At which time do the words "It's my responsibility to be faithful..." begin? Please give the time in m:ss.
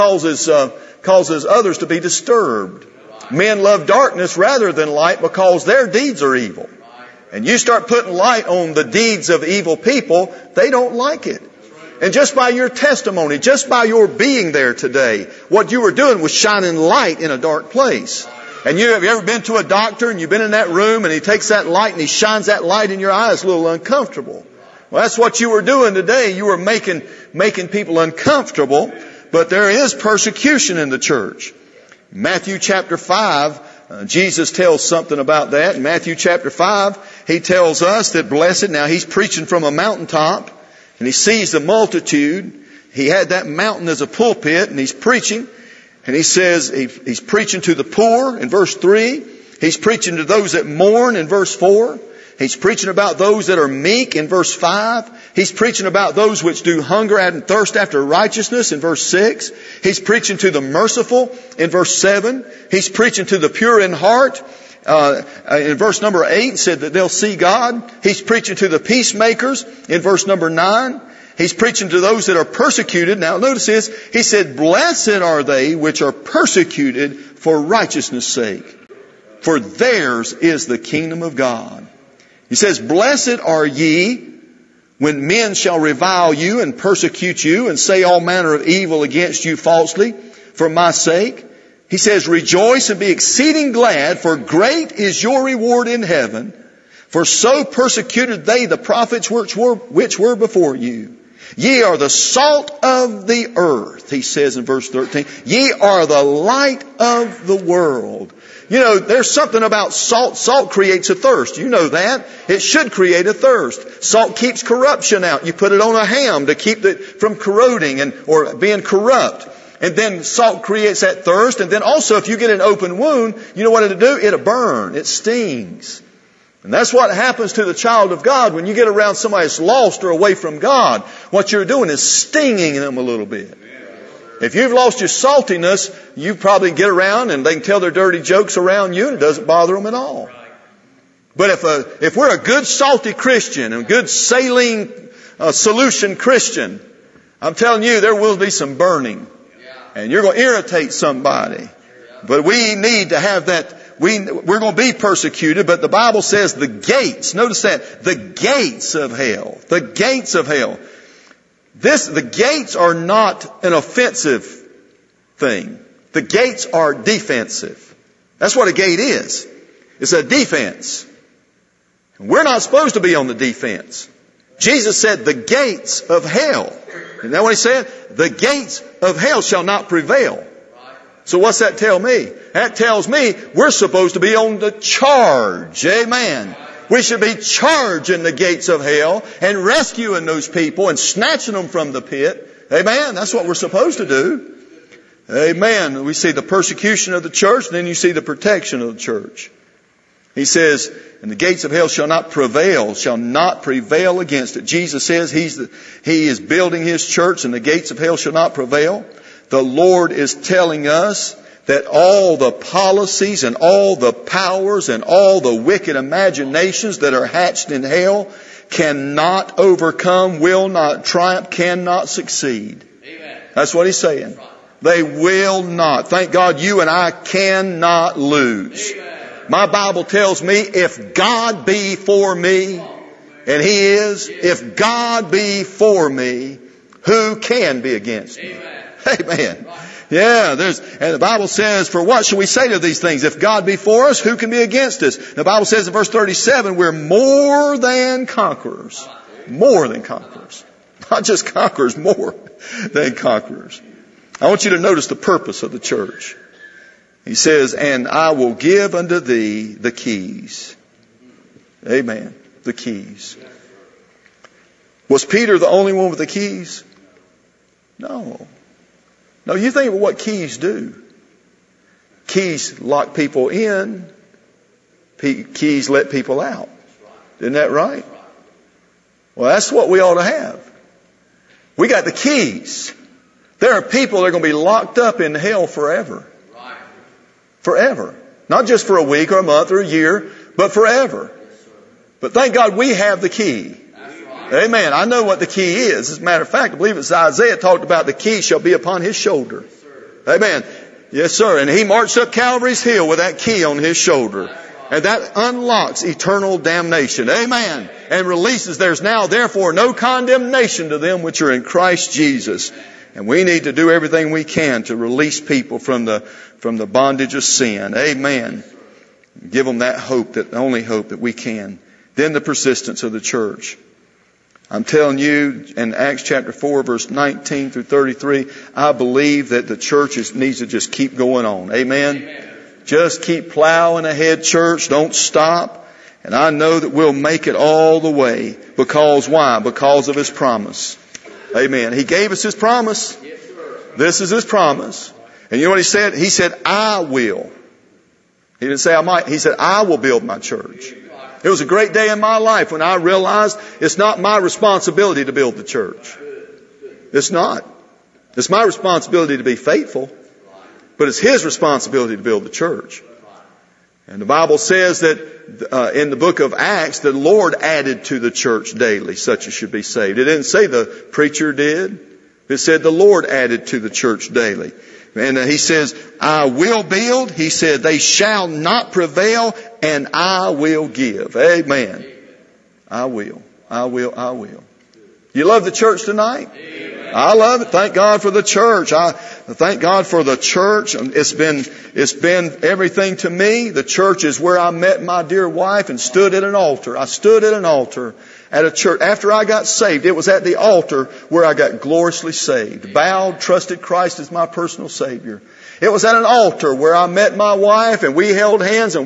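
5:58.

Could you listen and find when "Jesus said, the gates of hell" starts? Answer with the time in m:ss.
2:54.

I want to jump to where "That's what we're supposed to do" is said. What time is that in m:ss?
3:13.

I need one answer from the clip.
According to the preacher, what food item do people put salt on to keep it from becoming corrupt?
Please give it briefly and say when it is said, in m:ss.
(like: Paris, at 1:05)
Ham, at 1:56.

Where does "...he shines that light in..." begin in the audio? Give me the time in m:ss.
0:22.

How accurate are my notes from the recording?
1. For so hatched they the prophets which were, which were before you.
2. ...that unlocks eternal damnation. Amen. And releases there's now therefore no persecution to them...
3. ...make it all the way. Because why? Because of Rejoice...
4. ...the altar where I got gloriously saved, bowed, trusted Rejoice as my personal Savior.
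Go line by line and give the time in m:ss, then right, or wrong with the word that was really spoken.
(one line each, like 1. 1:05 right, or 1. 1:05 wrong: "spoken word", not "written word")
1. 1:37 wrong: "persecuted", not "hatched"
2. 5:05 wrong: "condemnation", not "persecution"
3. 5:37 wrong: "His", not "Rejoice"
4. 6:40 wrong: "Christ", not "Rejoice".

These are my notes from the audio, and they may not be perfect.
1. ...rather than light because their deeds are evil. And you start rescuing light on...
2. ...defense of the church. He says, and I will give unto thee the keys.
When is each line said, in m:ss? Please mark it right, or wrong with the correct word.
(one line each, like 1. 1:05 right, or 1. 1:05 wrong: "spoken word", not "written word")
1. 0:04 wrong: "putting", not "rescuing"
2. 4:15 wrong: "purpose", not "defense".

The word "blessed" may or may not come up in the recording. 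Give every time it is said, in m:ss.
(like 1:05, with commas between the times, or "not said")
0:38, 1:14, 1:22.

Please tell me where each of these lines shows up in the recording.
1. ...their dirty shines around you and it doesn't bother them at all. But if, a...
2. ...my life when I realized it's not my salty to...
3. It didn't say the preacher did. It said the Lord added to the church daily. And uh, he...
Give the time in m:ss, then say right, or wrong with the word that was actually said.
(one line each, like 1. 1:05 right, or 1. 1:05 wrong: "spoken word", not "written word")
1. 2:17 wrong: "jokes", not "shines"
2. 5:52 wrong: "responsibility", not "salty"
3. 6:10 right.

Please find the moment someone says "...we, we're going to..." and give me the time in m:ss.
2:34.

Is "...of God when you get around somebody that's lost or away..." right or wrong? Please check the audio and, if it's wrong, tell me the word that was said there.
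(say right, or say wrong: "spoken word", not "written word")
right.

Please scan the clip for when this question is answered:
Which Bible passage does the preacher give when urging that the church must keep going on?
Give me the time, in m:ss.
5:25.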